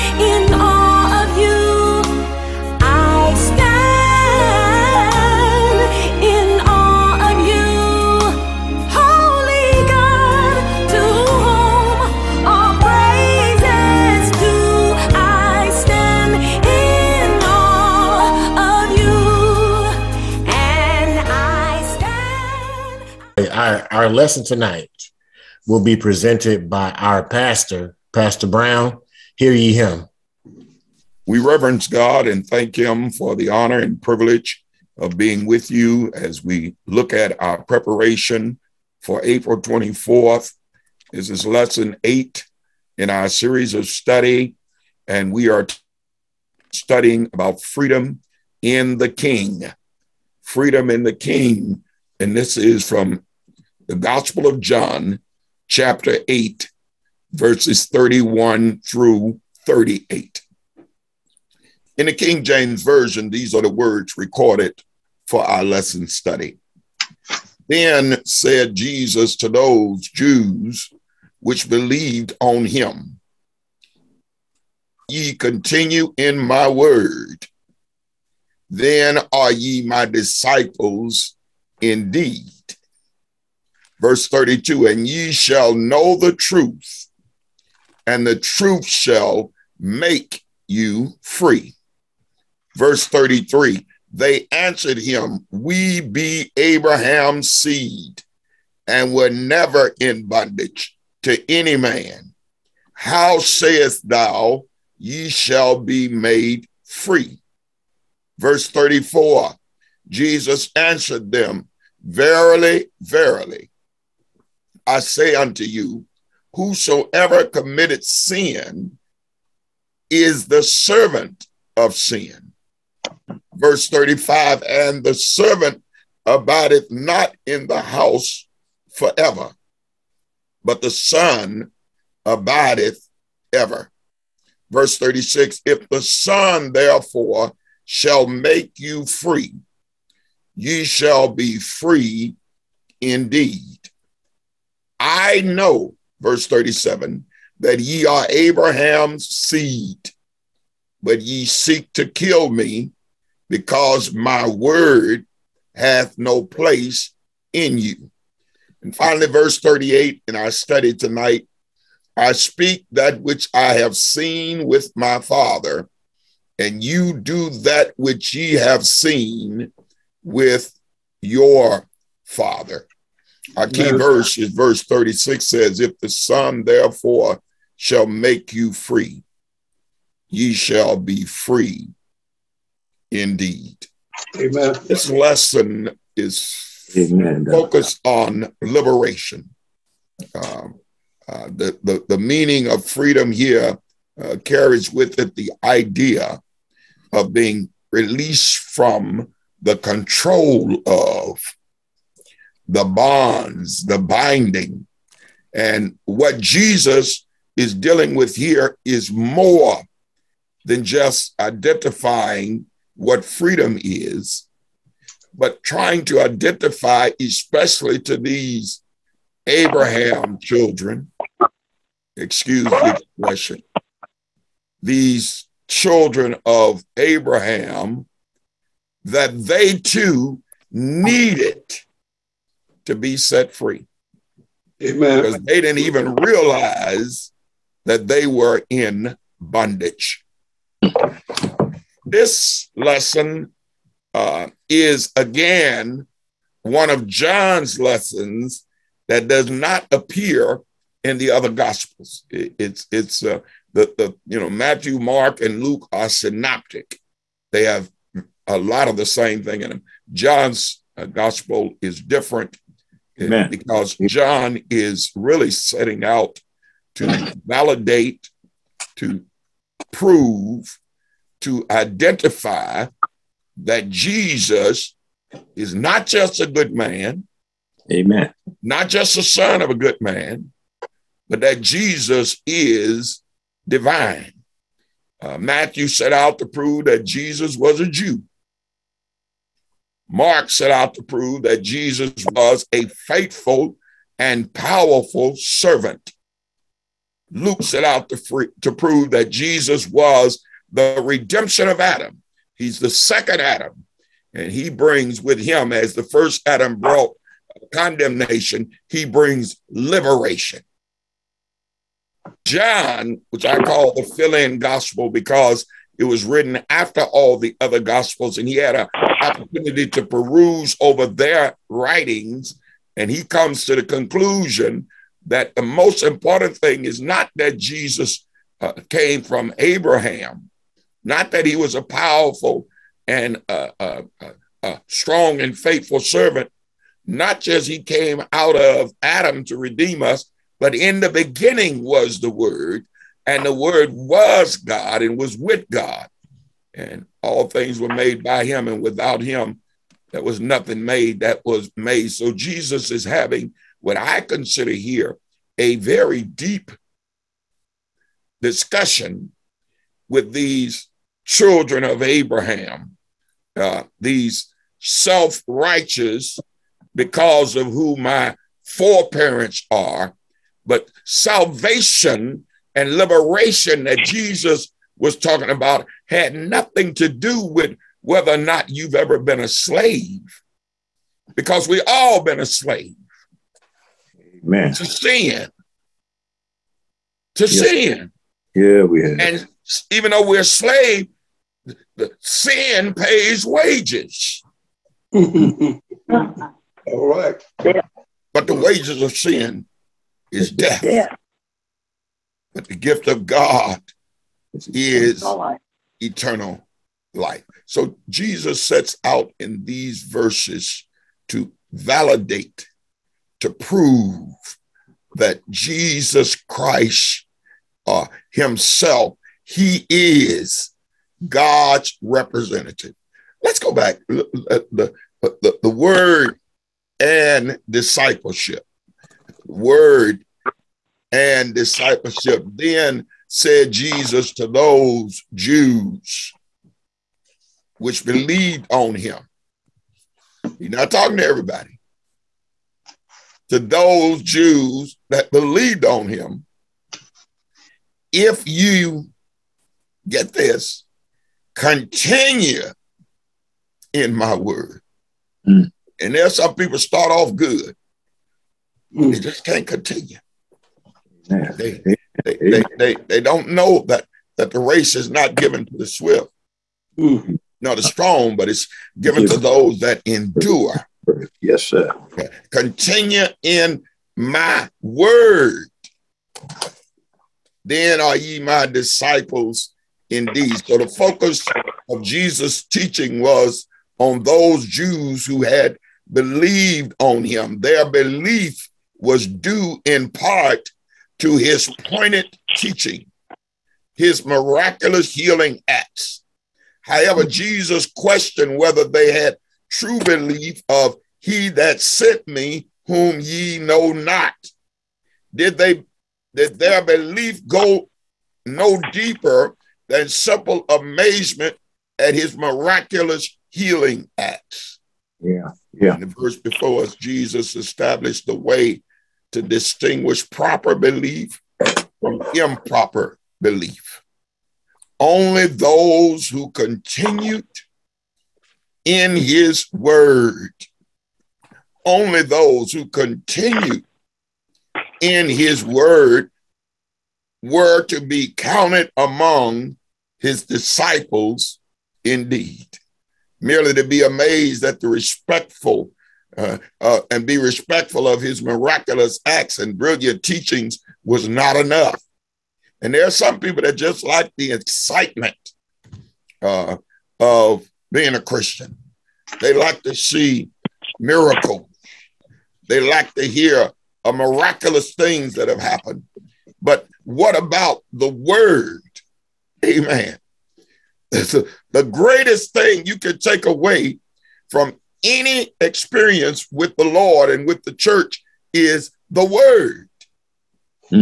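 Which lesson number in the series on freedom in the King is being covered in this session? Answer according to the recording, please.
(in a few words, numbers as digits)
8.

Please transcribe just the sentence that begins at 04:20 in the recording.
John's uh, gospel is different Amen.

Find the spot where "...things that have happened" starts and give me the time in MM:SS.
09:24.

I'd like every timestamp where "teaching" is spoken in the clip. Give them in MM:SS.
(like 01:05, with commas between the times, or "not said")
08:02, 08:12, 09:10.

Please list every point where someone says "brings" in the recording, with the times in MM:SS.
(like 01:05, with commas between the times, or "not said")
05:04, 05:09.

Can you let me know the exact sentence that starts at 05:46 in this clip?
And all things were made by him, and without him, there was nothing made that was made.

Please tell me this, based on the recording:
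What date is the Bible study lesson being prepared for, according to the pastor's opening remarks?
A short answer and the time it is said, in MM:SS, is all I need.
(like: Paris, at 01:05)
April 24th, at 00:39.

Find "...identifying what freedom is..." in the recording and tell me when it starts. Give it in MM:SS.
03:31.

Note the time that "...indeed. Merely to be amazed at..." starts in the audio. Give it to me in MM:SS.
09:02.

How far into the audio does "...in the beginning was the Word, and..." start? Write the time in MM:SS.
05:40.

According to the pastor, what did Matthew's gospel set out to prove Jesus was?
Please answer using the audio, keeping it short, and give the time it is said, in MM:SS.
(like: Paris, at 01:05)
A Jew, at 04:47.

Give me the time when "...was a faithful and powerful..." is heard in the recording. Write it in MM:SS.
04:52.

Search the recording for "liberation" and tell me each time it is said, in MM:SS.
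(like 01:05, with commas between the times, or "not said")
03:08, 05:09, 06:12.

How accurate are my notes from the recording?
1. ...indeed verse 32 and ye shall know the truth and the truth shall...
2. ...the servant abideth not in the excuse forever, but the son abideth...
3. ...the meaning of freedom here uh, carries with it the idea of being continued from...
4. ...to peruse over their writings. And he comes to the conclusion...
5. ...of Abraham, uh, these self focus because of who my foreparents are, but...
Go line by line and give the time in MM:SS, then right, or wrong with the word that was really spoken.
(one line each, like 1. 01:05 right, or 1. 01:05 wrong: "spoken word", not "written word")
1. 01:21 right
2. 02:05 wrong: "house", not "excuse"
3. 03:12 wrong: "released", not "continued"
4. 05:19 right
5. 06:01 wrong: "righteous", not "focus".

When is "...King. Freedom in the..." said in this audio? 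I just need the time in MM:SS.
00:49.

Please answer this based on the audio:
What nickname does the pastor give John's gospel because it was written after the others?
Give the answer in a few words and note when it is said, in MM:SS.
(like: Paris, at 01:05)
The fill in gospel, at 05:13.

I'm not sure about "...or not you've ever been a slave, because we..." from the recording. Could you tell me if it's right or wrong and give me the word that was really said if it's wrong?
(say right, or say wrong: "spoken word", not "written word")
right.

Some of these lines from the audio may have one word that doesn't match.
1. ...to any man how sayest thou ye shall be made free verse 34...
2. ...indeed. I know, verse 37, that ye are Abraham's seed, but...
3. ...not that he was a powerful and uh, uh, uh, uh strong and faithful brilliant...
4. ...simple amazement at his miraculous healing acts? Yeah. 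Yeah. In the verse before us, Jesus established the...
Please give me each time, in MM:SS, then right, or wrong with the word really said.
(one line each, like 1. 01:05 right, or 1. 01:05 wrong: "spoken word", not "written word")
1. 01:41 right
2. 02:23 right
3. 05:31 wrong: "servant", not "brilliant"
4. 08:30 right.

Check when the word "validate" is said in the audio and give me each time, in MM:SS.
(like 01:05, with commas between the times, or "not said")
04:27, 06:51.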